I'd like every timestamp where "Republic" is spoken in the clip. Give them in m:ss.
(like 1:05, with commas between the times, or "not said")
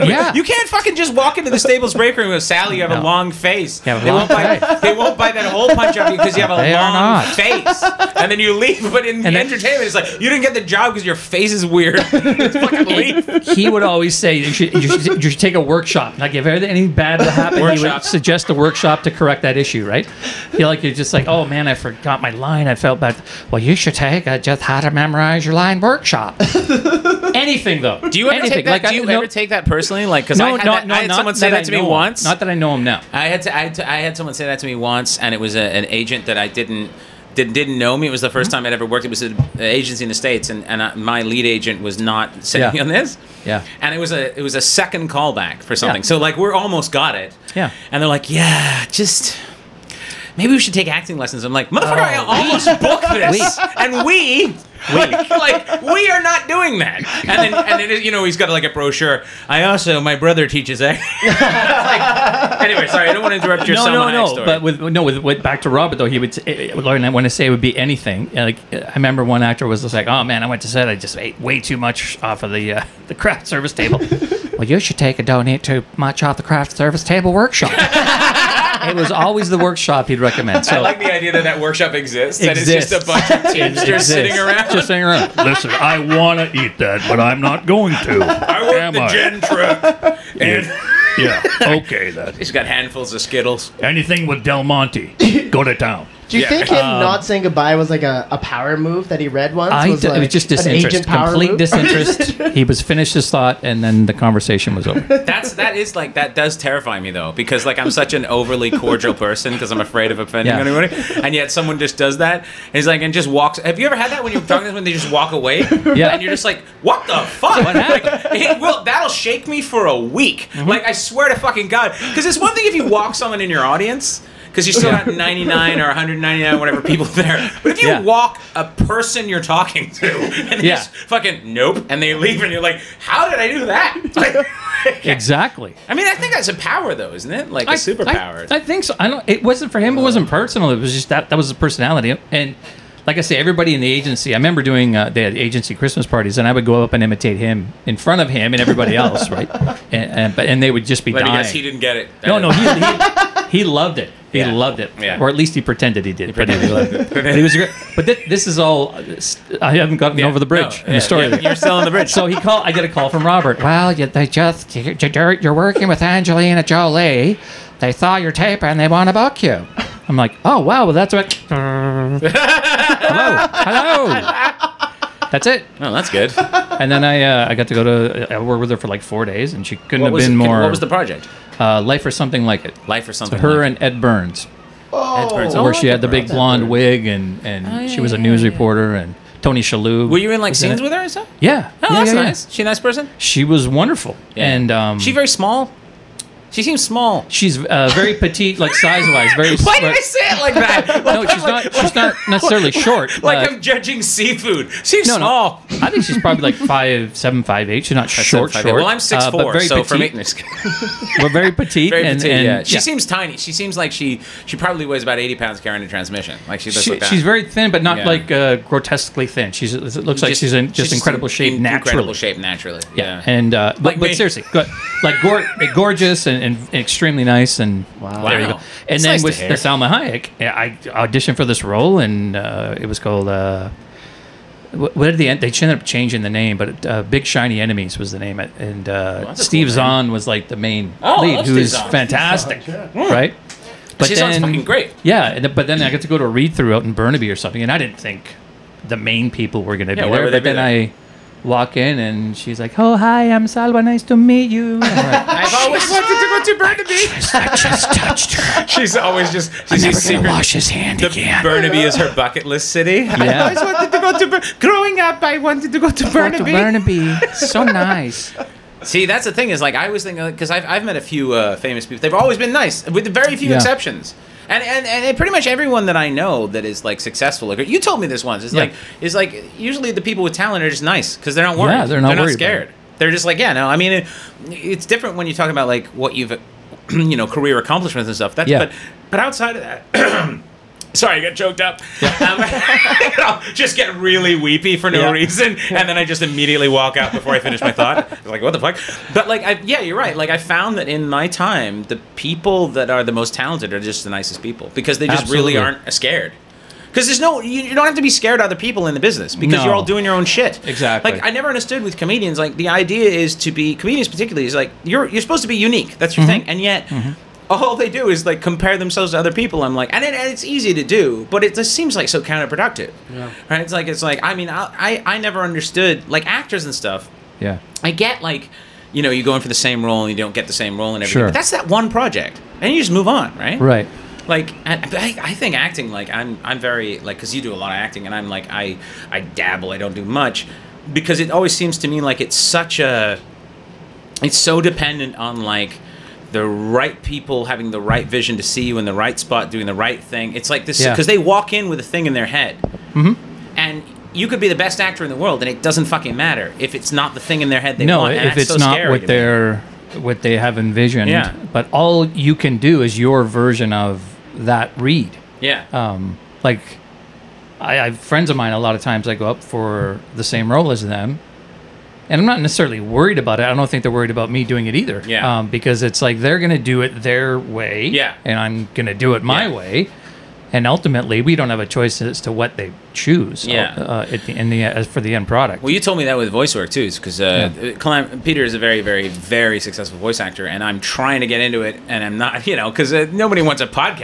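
not said.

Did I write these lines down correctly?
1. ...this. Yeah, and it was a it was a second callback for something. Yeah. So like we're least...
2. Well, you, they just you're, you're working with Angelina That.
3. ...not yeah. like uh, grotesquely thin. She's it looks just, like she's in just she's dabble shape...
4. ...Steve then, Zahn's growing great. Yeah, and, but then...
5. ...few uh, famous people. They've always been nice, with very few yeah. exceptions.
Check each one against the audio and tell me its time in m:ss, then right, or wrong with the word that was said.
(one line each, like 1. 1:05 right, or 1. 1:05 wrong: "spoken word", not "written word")
1. 0:43 wrong: "almost", not "least"
2. 2:43 wrong: "Jolie", not "That"
3. 3:37 wrong: "incredible", not "dabble"
4. 4:04 wrong: "fucking", not "growing"
5. 4:31 right.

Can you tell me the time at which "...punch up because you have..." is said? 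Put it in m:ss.
0:05.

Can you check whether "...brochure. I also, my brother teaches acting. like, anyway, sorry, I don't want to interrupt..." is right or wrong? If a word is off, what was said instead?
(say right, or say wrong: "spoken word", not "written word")
right.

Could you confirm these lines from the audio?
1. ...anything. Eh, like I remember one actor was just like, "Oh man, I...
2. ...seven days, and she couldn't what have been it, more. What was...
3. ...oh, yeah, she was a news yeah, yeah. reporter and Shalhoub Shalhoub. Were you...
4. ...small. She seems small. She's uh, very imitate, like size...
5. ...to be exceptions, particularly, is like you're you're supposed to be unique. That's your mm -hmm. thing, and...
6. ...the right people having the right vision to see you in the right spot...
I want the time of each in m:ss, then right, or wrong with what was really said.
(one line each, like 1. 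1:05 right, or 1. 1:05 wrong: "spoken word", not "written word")
1. 1:07 right
2. 2:59 wrong: "four", not "seven"
3. 3:07 wrong: "Tony", not "Shalhoub"
4. 3:15 wrong: "petite", not "imitate"
5. 5:13 wrong: "comedians", not "exceptions"
6. 5:46 right.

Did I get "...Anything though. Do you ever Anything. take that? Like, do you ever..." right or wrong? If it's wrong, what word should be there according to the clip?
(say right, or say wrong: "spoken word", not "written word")
right.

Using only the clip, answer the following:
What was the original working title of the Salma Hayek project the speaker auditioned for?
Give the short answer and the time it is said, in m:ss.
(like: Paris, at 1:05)
Big Shiny Enemies, at 3:57.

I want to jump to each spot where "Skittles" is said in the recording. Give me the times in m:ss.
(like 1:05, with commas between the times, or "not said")
1:33.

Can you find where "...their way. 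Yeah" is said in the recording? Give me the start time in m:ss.
6:16.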